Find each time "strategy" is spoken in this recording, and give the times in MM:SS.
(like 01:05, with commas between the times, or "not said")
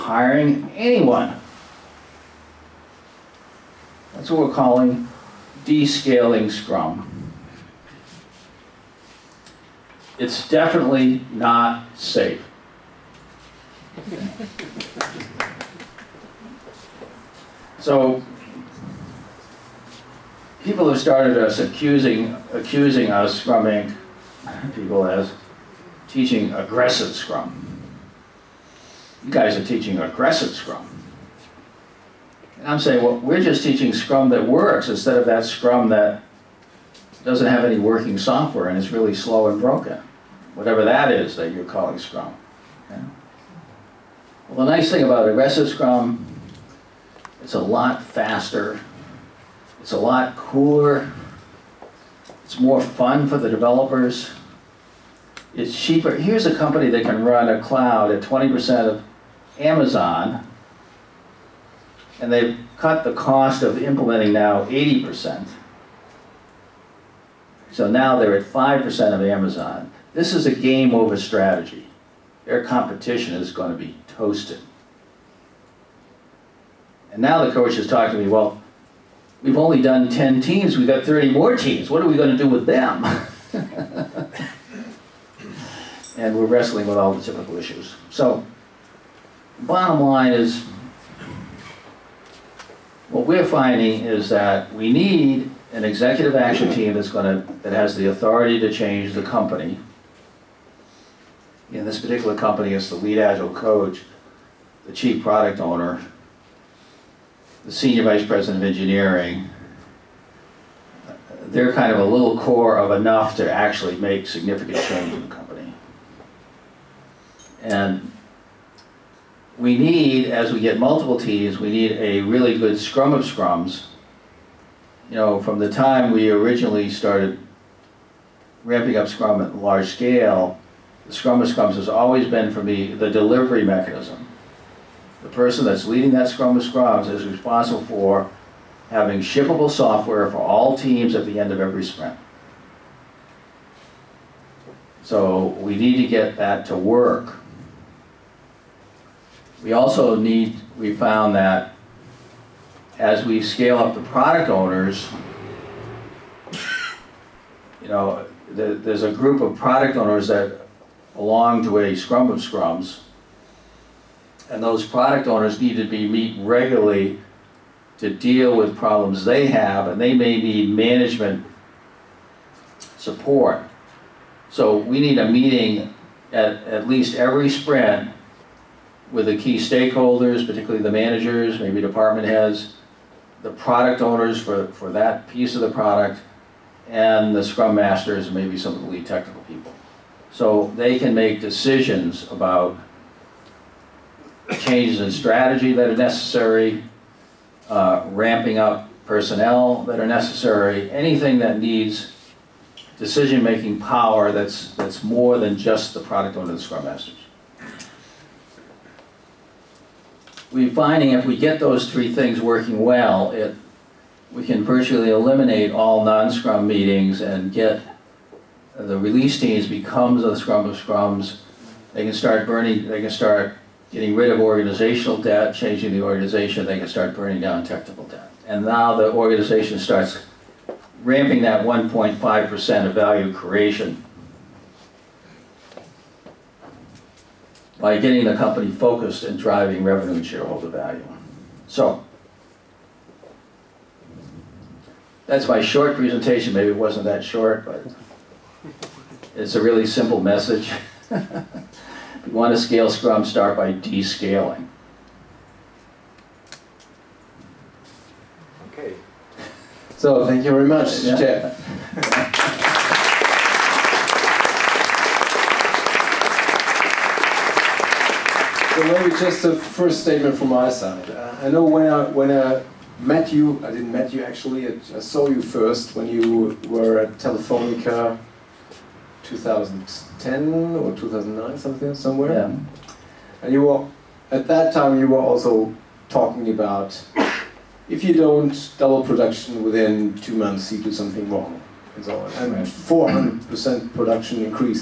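01:11, 03:15.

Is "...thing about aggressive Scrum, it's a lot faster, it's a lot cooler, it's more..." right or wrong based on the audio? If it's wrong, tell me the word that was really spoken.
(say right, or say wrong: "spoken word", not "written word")
right.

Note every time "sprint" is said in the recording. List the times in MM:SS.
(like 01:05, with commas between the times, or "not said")
02:21, 02:57.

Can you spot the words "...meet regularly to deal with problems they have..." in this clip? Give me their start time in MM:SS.
02:46.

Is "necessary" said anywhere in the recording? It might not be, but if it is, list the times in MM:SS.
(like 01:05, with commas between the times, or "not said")
03:15, 03:20.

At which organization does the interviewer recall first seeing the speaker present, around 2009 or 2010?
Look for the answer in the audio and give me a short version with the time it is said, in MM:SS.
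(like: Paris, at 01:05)
Telefonica, at 04:37.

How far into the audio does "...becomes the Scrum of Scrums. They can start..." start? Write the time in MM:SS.
03:39.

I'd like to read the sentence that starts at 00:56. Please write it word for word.
Here's a company that can run a cloud at 20% of Amazon, and they've cut the cost of implementing now 80%.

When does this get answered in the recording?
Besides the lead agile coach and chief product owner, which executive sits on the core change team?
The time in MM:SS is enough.
01:47.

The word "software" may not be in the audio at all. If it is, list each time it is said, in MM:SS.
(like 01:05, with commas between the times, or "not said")
00:38, 02:19.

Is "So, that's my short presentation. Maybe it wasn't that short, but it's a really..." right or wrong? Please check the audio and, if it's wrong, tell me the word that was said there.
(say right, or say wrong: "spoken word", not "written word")
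right.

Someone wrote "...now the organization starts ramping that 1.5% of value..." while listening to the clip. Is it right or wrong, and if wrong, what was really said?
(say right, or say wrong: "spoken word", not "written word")
right.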